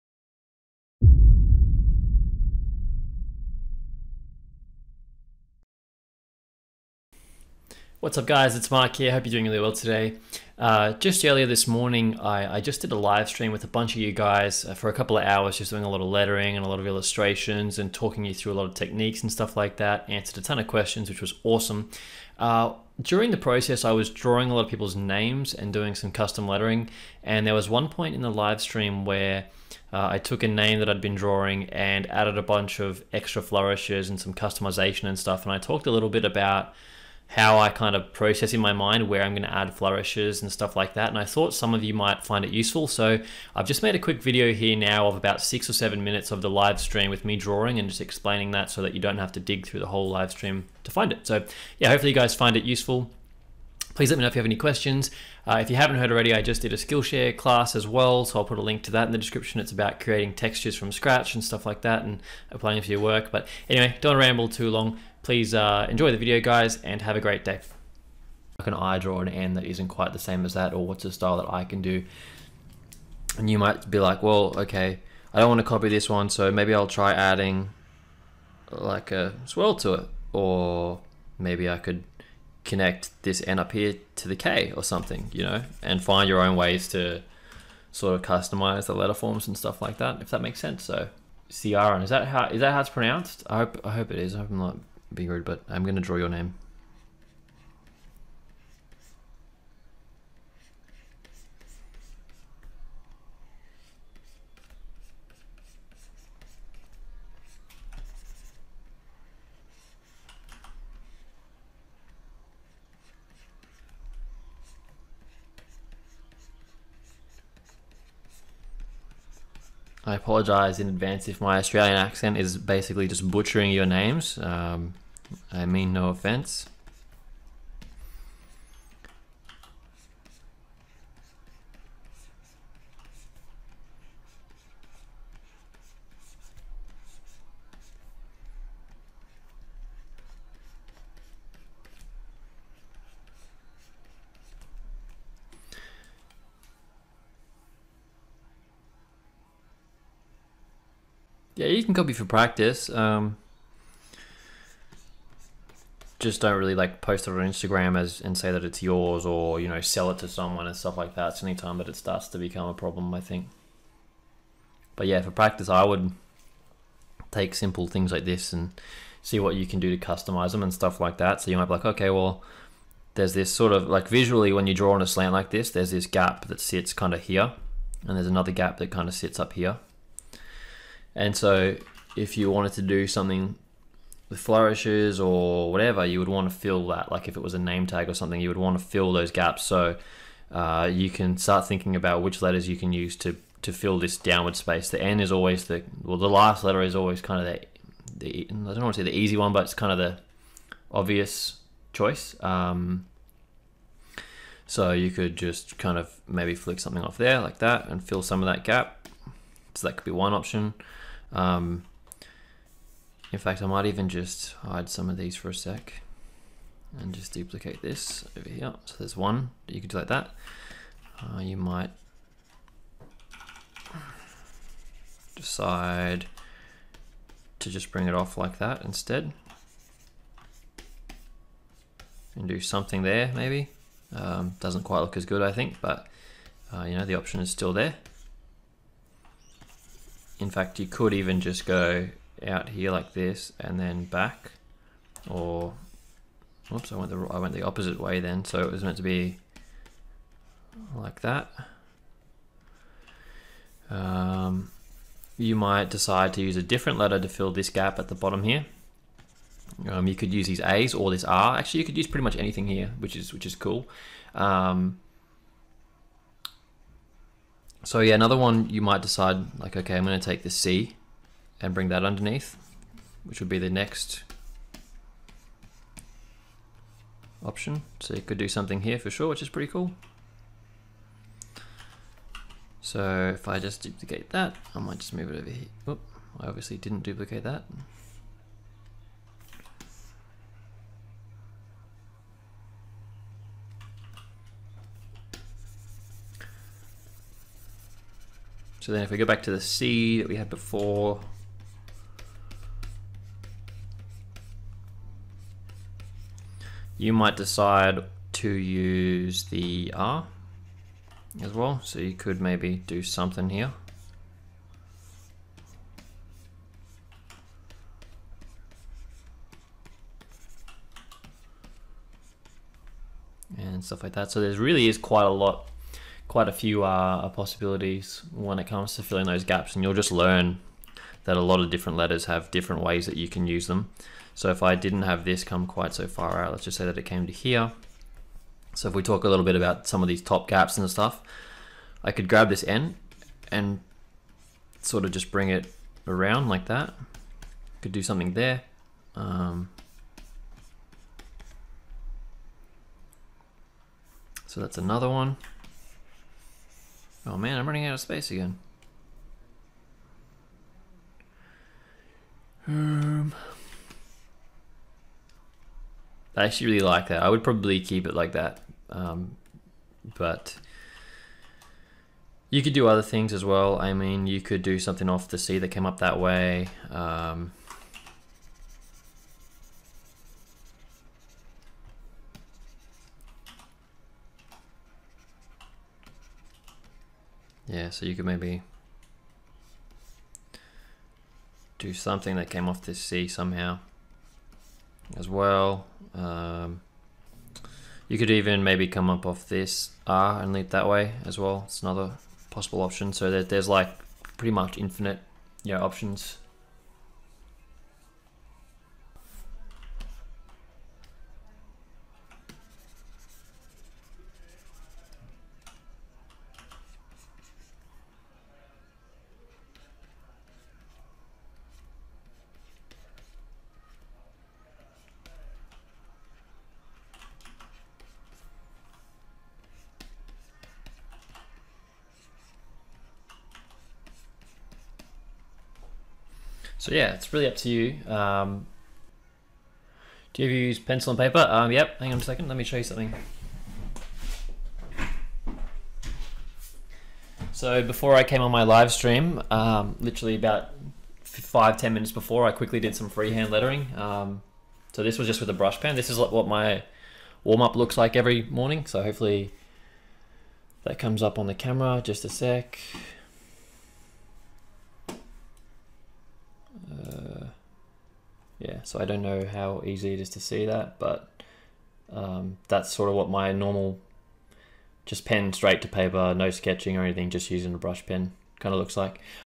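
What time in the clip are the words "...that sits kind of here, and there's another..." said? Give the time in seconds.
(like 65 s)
176 s.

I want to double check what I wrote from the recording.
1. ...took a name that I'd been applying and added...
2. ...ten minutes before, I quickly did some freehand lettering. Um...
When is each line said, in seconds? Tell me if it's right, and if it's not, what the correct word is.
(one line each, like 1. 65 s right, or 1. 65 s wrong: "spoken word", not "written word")
1. 30 s wrong: "drawing", not "applying"
2. 451 s right.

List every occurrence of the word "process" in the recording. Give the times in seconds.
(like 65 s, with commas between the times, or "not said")
23 s, 38 s.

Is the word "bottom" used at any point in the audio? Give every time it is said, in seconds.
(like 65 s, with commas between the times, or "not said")
258 s.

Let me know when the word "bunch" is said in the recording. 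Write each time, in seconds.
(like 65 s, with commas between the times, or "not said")
13 s, 32 s.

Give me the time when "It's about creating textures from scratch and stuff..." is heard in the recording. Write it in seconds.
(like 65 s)
59 s.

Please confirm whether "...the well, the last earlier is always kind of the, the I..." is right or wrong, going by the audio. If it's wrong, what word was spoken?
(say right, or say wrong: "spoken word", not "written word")
wrong: "letter", not "earlier".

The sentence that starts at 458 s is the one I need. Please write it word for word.
So hopefully that comes up on the camera, just a sec.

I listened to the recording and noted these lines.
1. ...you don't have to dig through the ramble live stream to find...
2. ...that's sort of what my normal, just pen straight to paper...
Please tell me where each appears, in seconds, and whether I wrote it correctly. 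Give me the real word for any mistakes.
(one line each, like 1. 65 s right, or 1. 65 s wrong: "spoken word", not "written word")
1. 48 s wrong: "whole", not "ramble"
2. 472 s right.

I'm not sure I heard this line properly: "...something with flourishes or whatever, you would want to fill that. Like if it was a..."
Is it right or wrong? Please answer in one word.
right.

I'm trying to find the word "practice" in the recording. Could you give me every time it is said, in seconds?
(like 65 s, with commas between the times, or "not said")
152 s, 165 s.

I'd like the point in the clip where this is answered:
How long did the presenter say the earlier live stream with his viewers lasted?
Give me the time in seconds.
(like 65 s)
14 s.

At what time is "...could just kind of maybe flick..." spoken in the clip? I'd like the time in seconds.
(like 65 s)
205 s.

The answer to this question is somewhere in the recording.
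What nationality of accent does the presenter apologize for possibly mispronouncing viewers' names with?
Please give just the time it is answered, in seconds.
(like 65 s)
121 s.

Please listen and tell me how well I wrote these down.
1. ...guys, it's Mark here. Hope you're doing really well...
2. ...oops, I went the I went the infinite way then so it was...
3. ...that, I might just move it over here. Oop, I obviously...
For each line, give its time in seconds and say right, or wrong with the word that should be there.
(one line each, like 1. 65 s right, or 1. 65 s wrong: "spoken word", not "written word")
1. 8 s right
2. 246 s wrong: "opposite", not "infinite"
3. 284 s right.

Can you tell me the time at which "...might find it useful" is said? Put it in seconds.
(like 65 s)
41 s.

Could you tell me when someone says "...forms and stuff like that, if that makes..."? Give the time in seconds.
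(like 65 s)
89 s.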